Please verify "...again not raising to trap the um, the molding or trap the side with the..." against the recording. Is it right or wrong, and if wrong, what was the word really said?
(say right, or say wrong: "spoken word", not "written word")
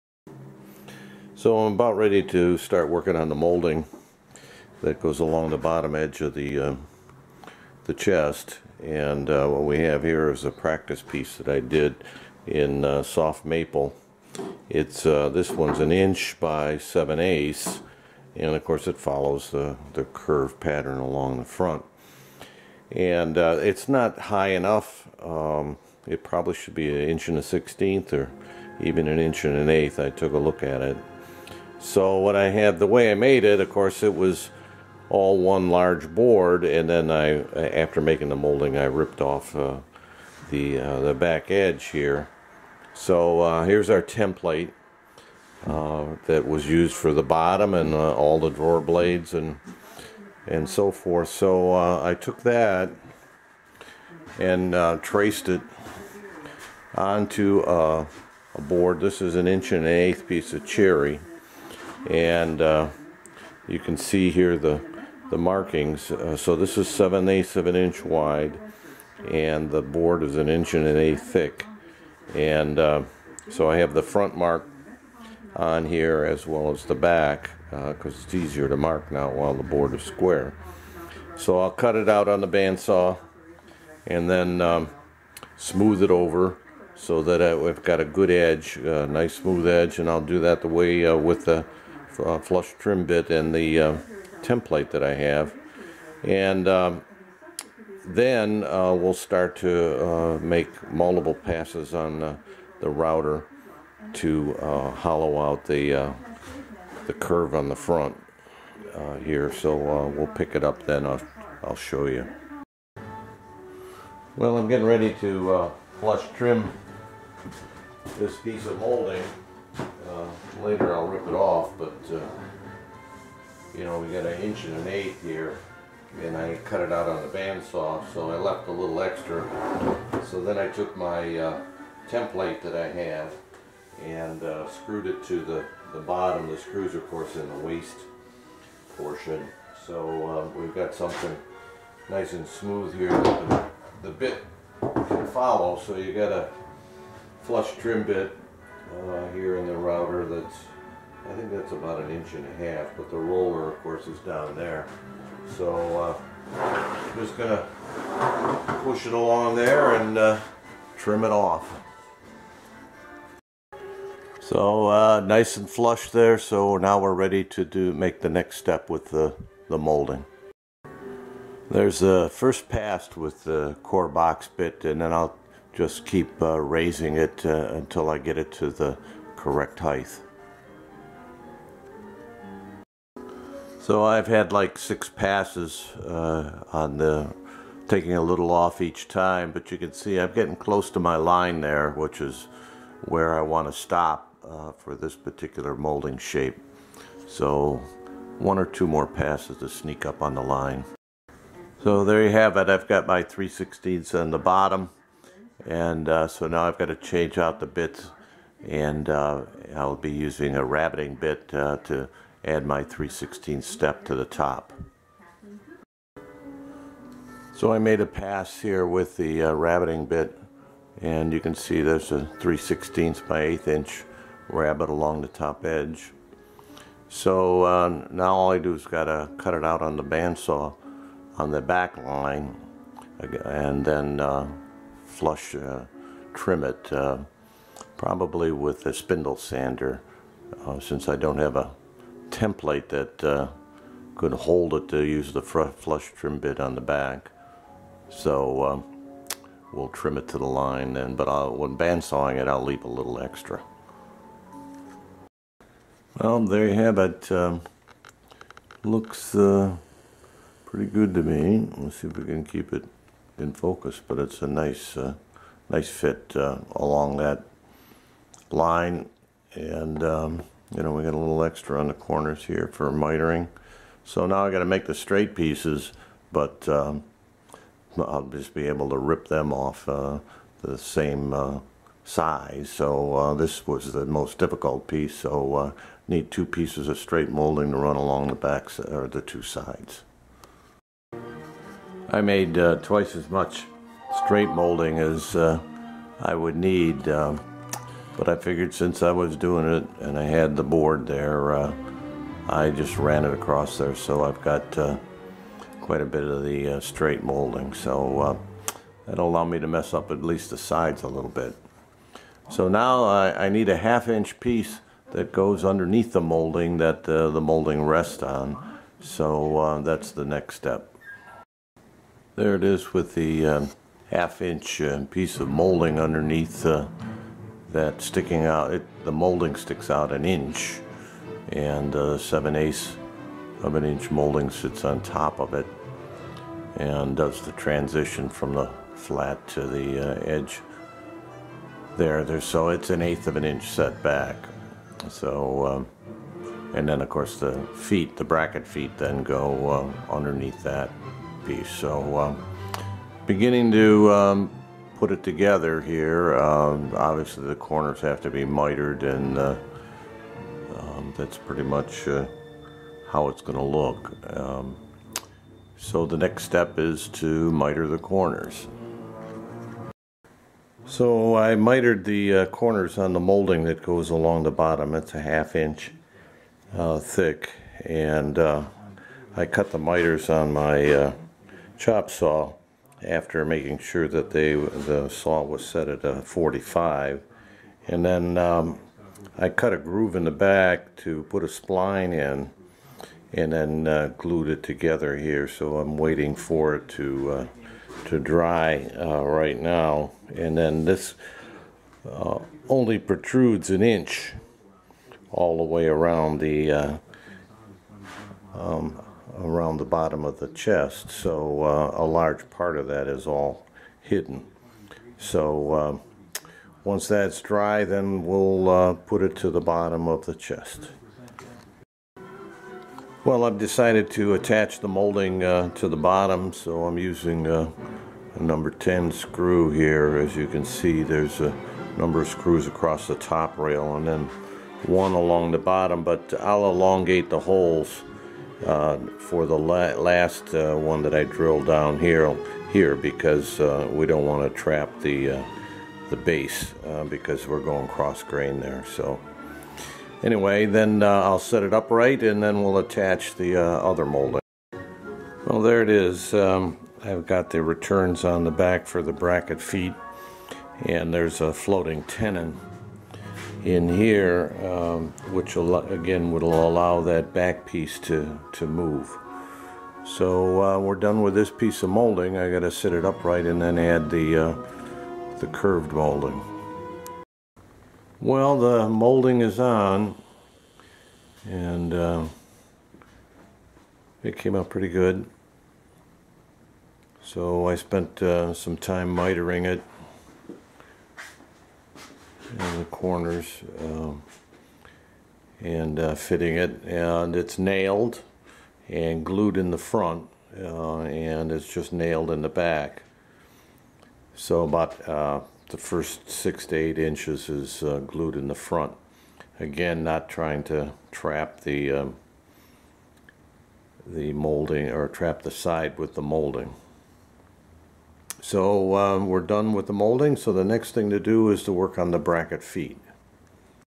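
wrong: "trying", not "raising".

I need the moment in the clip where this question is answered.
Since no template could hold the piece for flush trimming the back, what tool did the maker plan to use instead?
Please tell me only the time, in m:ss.
3:58.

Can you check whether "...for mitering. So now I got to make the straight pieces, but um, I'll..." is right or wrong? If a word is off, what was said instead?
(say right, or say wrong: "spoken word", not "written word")
right.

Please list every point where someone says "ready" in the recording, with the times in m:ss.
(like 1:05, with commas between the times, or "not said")
0:01, 1:54, 2:47.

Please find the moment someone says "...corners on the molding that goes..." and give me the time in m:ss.
6:12.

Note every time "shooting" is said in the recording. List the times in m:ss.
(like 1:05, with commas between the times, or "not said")
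not said.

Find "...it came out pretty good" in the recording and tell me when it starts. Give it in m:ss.
8:04.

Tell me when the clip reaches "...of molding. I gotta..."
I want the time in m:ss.
7:51.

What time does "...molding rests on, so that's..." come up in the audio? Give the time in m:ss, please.
5:17.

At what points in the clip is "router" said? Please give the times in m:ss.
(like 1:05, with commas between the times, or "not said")
1:42, 2:29.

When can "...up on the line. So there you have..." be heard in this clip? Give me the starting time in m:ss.
3:20.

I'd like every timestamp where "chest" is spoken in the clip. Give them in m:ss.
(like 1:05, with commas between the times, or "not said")
0:07, 6:50, 7:00.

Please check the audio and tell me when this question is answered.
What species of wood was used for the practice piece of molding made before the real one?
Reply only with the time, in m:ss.
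0:13.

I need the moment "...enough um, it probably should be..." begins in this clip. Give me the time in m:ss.
0:24.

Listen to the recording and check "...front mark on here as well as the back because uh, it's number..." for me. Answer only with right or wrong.
wrong.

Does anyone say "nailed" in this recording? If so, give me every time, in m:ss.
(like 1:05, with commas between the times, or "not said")
8:17, 8:21.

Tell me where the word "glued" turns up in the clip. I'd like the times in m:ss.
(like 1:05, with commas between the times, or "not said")
6:34, 8:19, 8:27.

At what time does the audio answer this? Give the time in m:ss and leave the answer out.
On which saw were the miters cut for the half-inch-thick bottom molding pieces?
6:21.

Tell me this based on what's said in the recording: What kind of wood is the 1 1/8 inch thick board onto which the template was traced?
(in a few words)
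cherry.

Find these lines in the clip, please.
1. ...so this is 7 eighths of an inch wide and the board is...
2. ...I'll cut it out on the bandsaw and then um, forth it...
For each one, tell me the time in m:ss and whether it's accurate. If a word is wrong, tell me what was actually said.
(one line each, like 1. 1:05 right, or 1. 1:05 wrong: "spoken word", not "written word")
1. 1:06 right
2. 1:21 wrong: "smooth", not "forth".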